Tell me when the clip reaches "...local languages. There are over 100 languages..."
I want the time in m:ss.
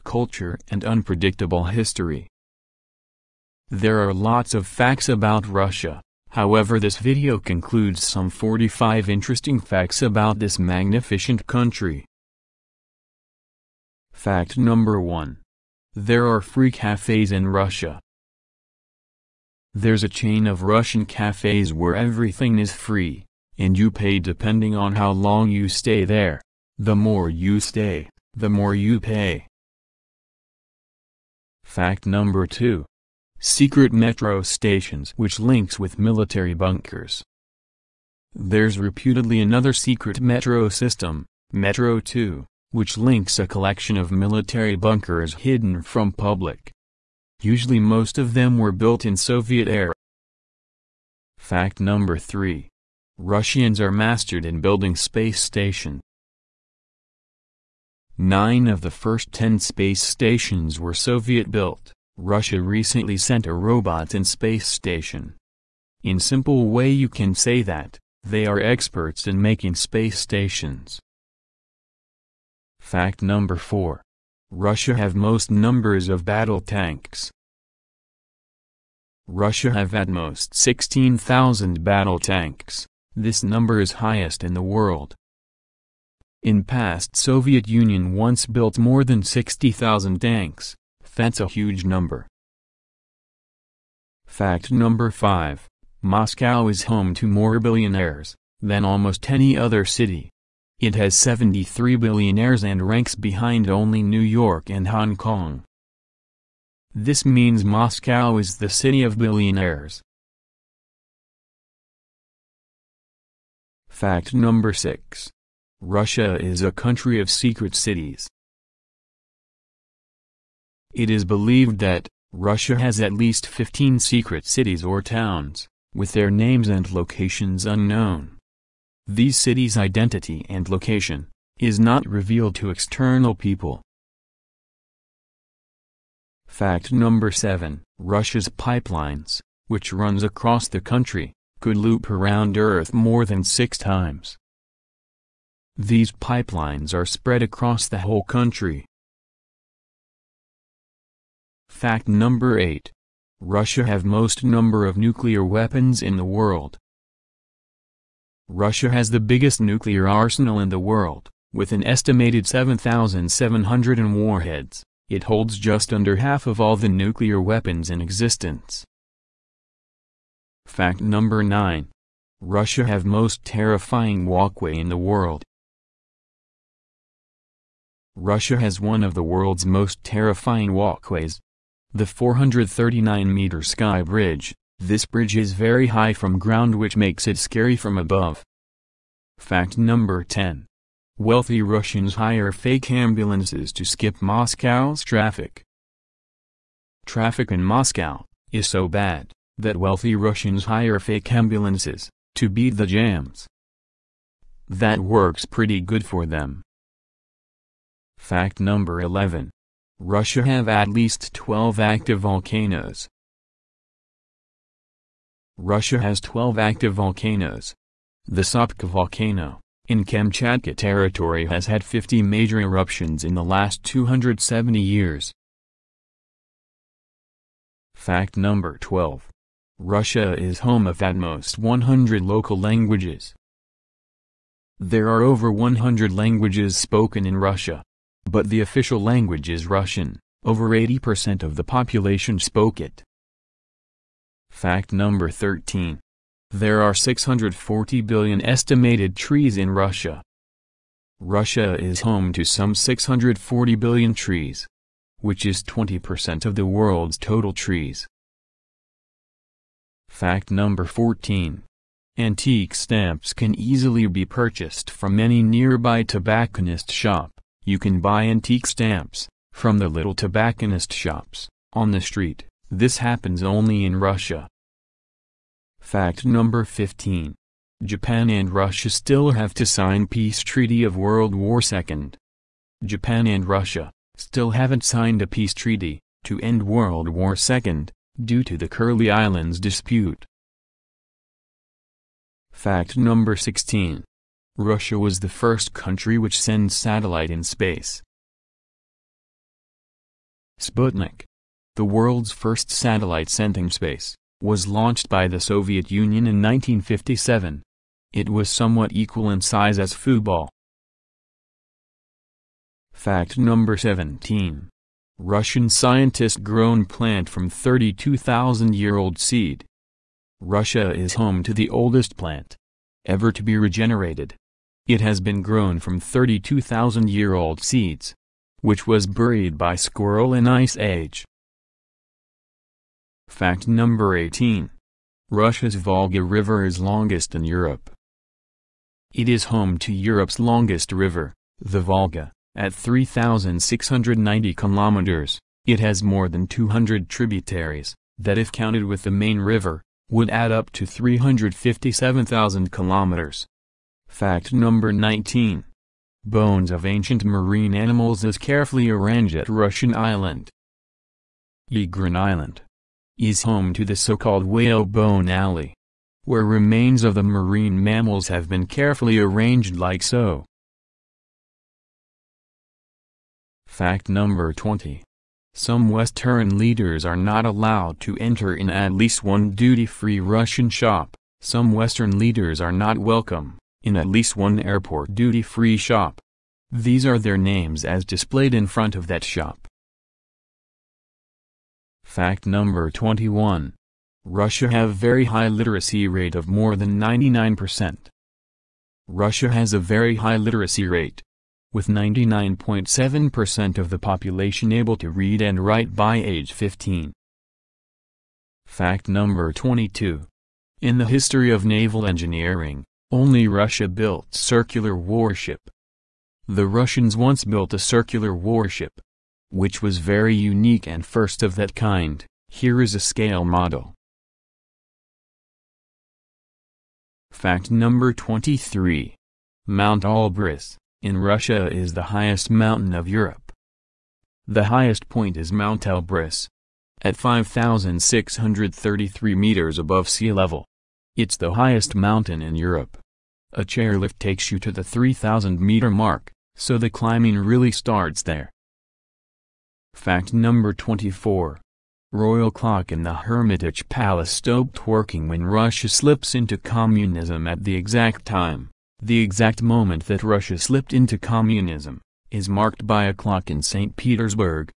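3:52.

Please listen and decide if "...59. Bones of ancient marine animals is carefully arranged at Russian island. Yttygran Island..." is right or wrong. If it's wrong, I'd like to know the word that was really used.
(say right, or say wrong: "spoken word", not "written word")
wrong: "19", not "59".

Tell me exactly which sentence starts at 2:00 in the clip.
It is believed that, Russia has at least 15 secret cities or towns, with their names and locations unknown.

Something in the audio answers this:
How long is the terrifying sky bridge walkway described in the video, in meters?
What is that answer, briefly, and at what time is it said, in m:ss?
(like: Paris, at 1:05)
439 meters, at 3:02.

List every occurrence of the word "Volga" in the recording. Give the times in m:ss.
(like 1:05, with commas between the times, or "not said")
5:35, 5:41.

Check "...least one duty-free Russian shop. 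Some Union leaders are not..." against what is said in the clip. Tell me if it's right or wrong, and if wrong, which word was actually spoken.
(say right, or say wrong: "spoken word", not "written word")
wrong: "Western", not "Union".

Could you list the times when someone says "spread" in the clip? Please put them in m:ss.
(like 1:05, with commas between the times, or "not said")
2:27.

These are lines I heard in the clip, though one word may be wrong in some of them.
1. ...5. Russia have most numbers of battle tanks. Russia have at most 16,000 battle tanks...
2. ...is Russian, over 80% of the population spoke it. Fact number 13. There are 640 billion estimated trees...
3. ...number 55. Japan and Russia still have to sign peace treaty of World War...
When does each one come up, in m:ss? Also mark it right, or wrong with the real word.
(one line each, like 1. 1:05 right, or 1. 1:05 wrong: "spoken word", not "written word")
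1. 1:13 wrong: "4", not "5"
2. 3:59 right
3. 4:36 wrong: "15", not "55".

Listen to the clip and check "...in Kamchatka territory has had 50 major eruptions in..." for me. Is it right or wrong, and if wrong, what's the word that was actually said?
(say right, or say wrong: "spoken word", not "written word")
right.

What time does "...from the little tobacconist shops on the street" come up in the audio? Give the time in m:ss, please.
4:29.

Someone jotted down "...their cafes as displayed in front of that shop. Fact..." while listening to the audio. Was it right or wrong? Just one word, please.
wrong.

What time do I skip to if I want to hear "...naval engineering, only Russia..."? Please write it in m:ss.
6:51.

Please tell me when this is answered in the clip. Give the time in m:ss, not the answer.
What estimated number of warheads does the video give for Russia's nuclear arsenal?
2:42.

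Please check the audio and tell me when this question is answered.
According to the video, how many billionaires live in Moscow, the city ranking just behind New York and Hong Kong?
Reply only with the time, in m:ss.
1:41.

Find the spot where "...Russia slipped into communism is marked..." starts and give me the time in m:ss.
7:40.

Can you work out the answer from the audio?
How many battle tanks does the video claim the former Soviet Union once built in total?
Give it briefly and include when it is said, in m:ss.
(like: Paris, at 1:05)
more than 60,000, at 1:28.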